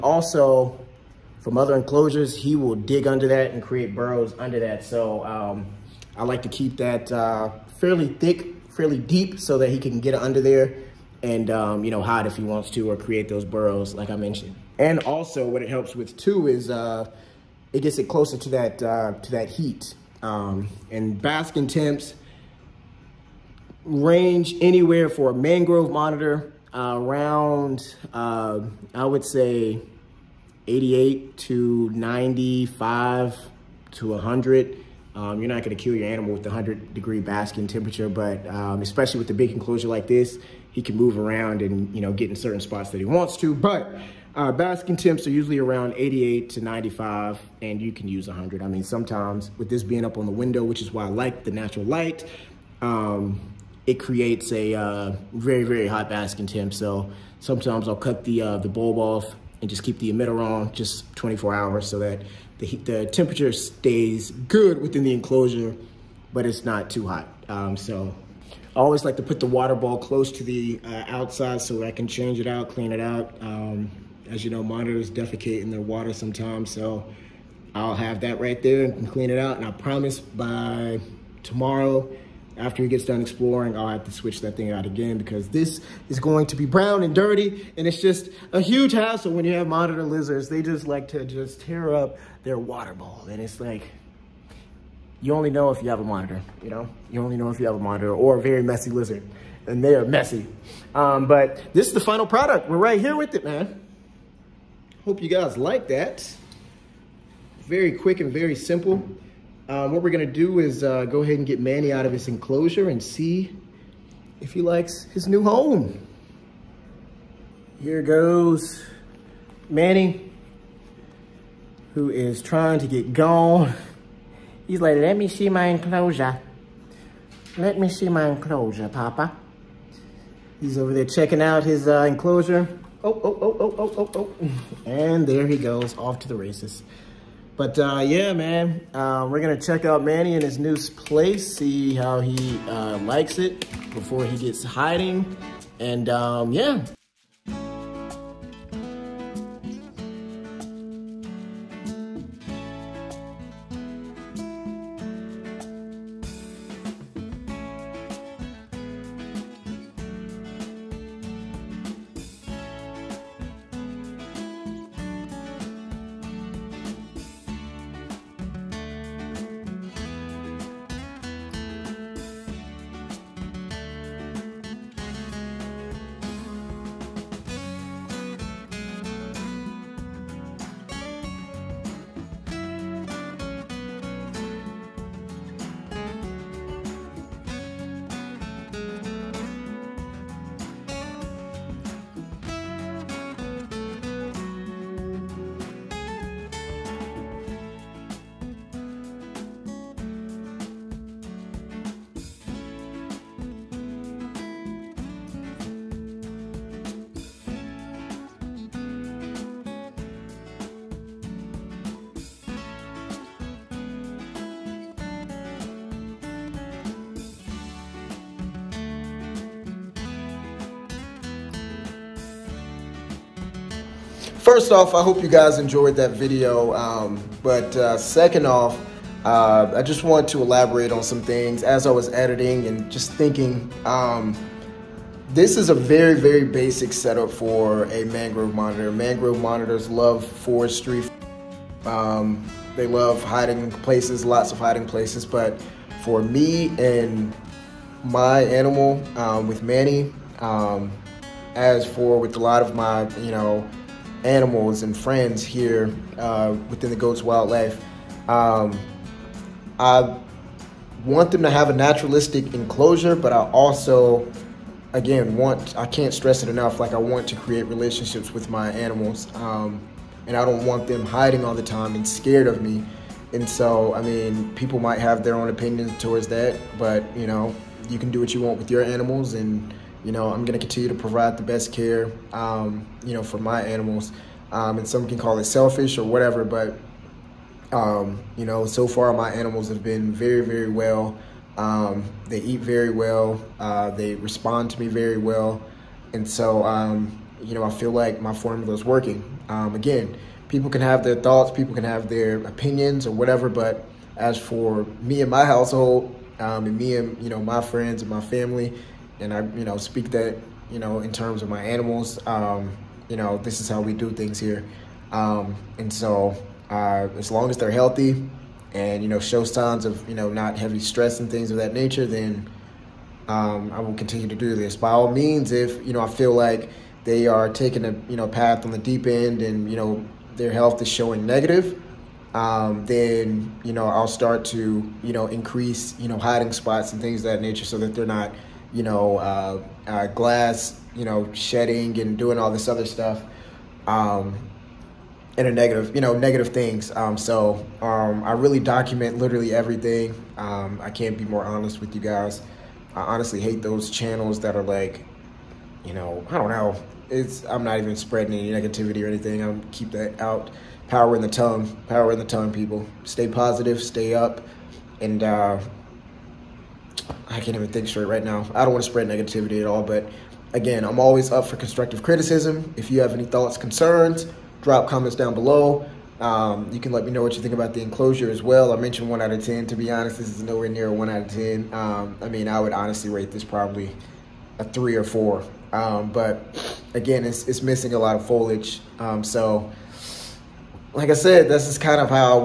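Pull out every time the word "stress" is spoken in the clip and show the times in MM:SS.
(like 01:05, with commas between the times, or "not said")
04:26, 05:20.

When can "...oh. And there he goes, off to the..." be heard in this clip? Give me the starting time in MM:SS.
02:14.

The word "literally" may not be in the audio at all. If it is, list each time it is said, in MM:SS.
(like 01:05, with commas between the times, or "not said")
05:49.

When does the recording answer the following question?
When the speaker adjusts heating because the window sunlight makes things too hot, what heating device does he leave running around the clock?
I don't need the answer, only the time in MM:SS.
00:59.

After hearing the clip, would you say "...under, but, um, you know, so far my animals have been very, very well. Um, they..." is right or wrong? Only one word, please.
wrong.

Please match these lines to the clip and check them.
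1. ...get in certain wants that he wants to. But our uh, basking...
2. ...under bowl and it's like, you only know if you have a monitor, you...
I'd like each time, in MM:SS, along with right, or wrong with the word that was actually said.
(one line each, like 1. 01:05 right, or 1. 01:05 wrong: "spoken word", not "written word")
1. 00:42 wrong: "spots", not "wants"
2. 01:32 wrong: "water", not "under".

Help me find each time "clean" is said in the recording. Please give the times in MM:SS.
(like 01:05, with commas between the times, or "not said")
01:12, 01:19.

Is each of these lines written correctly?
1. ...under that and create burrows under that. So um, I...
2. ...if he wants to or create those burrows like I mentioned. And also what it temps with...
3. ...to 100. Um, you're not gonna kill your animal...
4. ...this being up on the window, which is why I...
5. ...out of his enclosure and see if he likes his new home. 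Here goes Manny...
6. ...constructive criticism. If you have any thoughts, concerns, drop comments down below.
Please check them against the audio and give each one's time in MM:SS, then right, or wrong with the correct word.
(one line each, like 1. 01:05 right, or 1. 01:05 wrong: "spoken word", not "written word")
1. 00:03 right
2. 00:12 wrong: "helps", not "temps"
3. 00:33 right
4. 00:49 right
5. 01:51 right
6. 06:11 right.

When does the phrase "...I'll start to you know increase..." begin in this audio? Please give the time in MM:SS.
05:33.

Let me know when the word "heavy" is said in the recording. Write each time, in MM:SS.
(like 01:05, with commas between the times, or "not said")
05:20.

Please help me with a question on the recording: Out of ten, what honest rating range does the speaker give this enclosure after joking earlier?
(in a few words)
3 or 4.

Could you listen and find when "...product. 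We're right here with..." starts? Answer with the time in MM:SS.
01:42.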